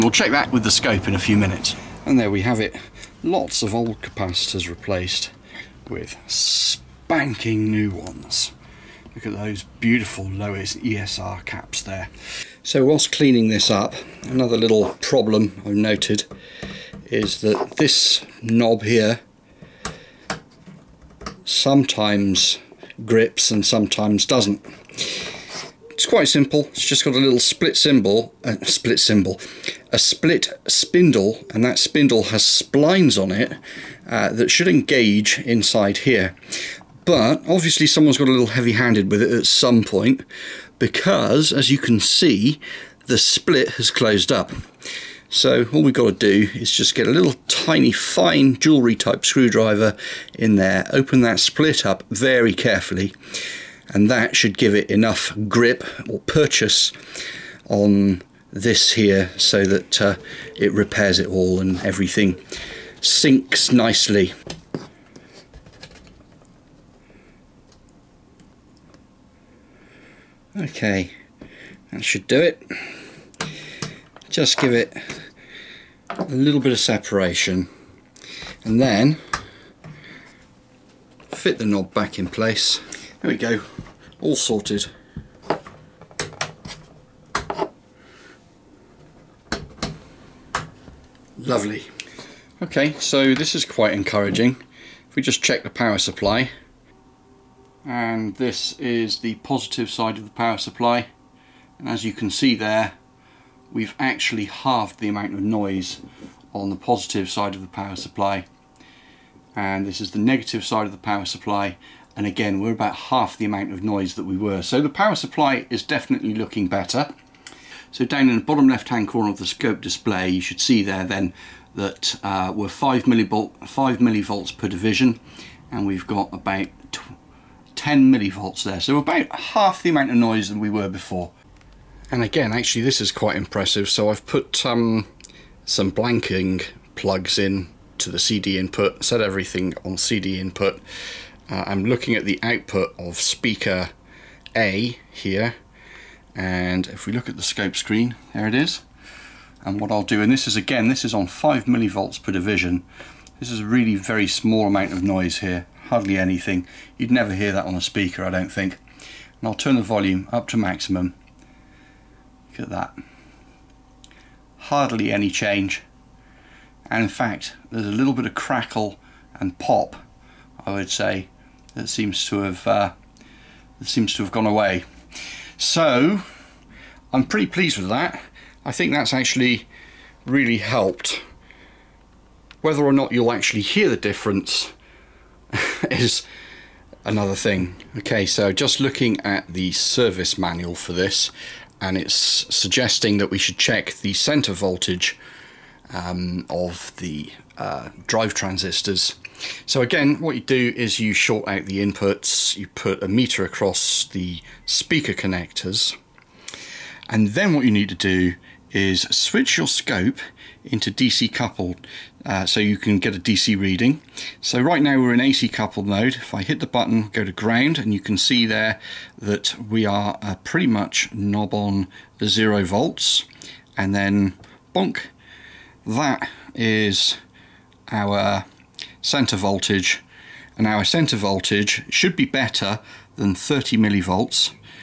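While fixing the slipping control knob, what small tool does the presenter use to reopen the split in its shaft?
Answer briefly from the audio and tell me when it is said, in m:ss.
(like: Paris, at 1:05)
jewellery type screwdriver, at 0:48.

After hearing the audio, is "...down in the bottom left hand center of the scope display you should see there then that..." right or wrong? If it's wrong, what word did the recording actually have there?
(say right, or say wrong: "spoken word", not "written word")
wrong: "corner", not "center".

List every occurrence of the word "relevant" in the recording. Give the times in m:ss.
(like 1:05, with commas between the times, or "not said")
not said.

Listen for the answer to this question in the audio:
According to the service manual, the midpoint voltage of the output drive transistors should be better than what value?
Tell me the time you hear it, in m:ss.
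3:53.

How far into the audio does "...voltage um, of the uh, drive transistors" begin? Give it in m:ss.
3:14.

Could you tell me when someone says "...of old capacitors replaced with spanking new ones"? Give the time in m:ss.
0:03.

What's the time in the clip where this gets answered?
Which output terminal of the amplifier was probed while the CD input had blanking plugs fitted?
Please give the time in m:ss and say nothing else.
2:23.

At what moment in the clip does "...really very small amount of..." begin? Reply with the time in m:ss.
2:33.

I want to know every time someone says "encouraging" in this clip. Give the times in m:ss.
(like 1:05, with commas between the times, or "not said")
1:33.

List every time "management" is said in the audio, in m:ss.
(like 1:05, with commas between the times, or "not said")
not said.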